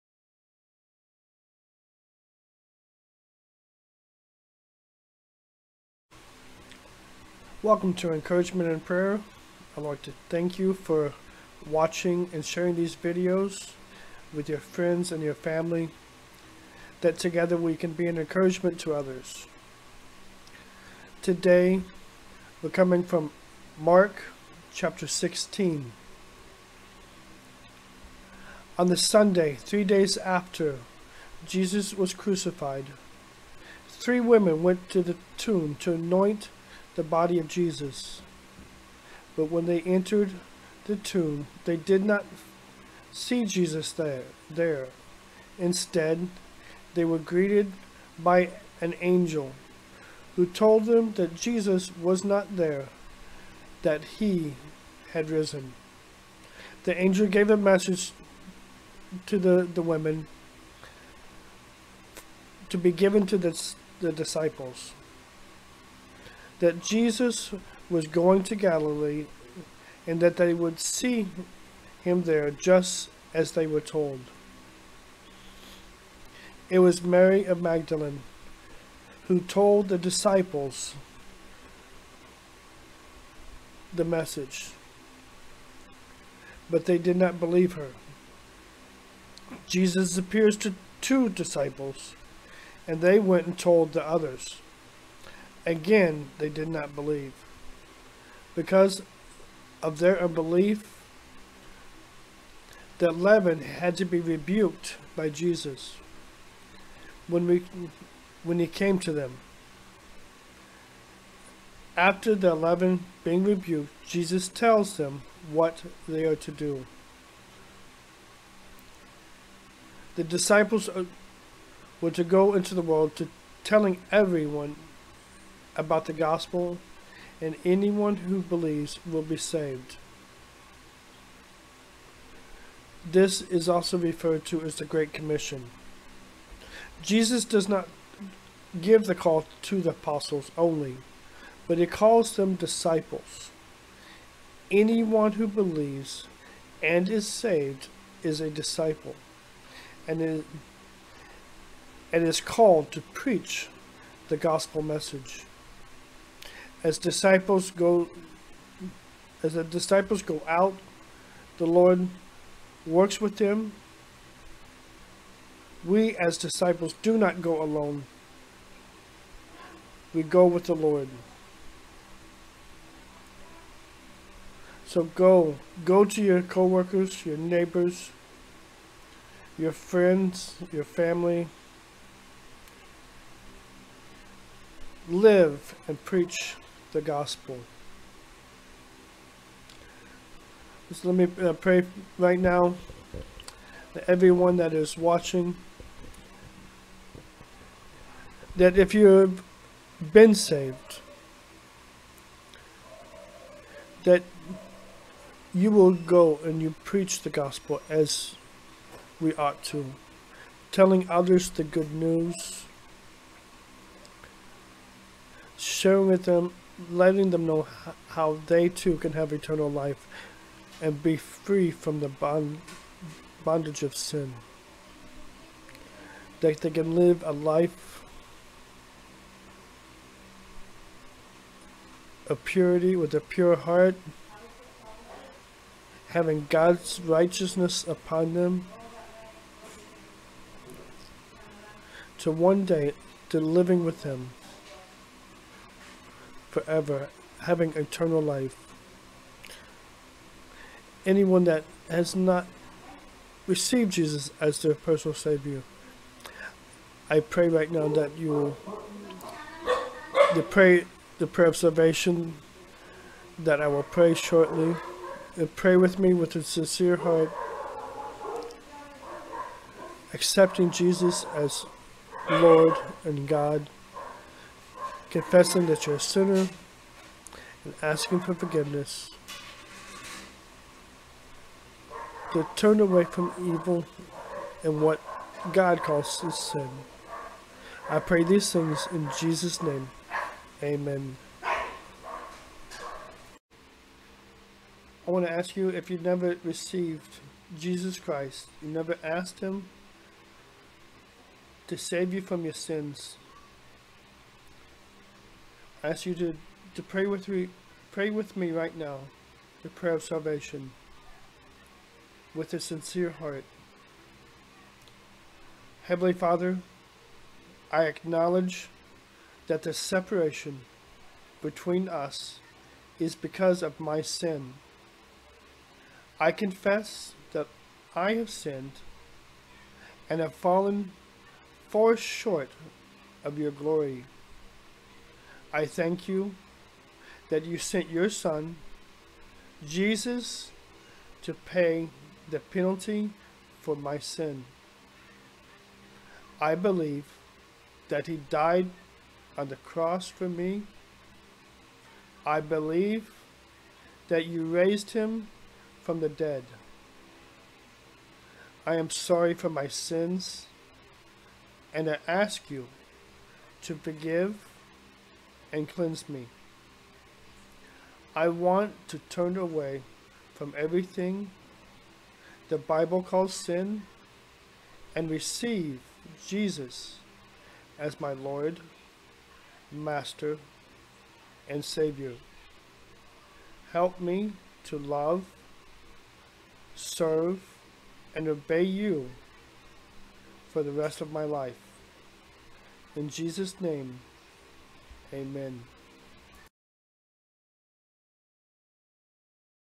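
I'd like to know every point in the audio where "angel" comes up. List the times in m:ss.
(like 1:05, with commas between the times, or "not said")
0:49, 0:56.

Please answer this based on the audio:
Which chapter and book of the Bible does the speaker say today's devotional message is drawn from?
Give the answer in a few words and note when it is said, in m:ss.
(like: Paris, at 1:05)
Mark 16, at 0:23.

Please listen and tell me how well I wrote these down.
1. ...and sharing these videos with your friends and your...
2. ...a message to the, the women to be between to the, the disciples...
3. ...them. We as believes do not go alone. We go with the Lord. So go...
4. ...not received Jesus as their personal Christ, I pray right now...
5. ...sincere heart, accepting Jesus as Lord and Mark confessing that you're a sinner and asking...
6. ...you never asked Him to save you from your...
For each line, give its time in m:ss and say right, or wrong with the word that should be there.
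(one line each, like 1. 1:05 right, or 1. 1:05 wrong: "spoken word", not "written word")
1. 0:12 right
2. 0:57 wrong: "given", not "between"
3. 2:43 wrong: "disciples", not "believes"
4. 4:12 wrong: "Savior", not "Christ"
5. 4:26 wrong: "God", not "Mark"
6. 4:58 right.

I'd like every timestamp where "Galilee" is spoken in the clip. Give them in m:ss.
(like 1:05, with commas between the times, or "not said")
1:08.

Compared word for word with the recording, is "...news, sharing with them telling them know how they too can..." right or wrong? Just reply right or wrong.
wrong.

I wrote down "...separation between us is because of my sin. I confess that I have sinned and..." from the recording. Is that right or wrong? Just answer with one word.
right.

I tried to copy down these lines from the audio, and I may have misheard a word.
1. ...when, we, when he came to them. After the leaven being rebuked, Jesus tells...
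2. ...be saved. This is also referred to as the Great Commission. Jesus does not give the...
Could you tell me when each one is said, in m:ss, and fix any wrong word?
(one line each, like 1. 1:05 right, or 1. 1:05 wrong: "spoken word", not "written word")
1. 1:47 right
2. 2:09 right.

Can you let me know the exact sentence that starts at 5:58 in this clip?
I am sorry for my sins, and I ask you to forgive and cleanse me.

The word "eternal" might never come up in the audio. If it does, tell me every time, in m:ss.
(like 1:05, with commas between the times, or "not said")
3:39, 4:07.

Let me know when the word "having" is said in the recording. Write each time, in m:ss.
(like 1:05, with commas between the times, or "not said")
3:56, 4:07.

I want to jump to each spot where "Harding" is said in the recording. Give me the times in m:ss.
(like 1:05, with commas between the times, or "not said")
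not said.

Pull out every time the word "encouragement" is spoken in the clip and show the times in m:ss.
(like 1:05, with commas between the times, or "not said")
0:08, 0:18.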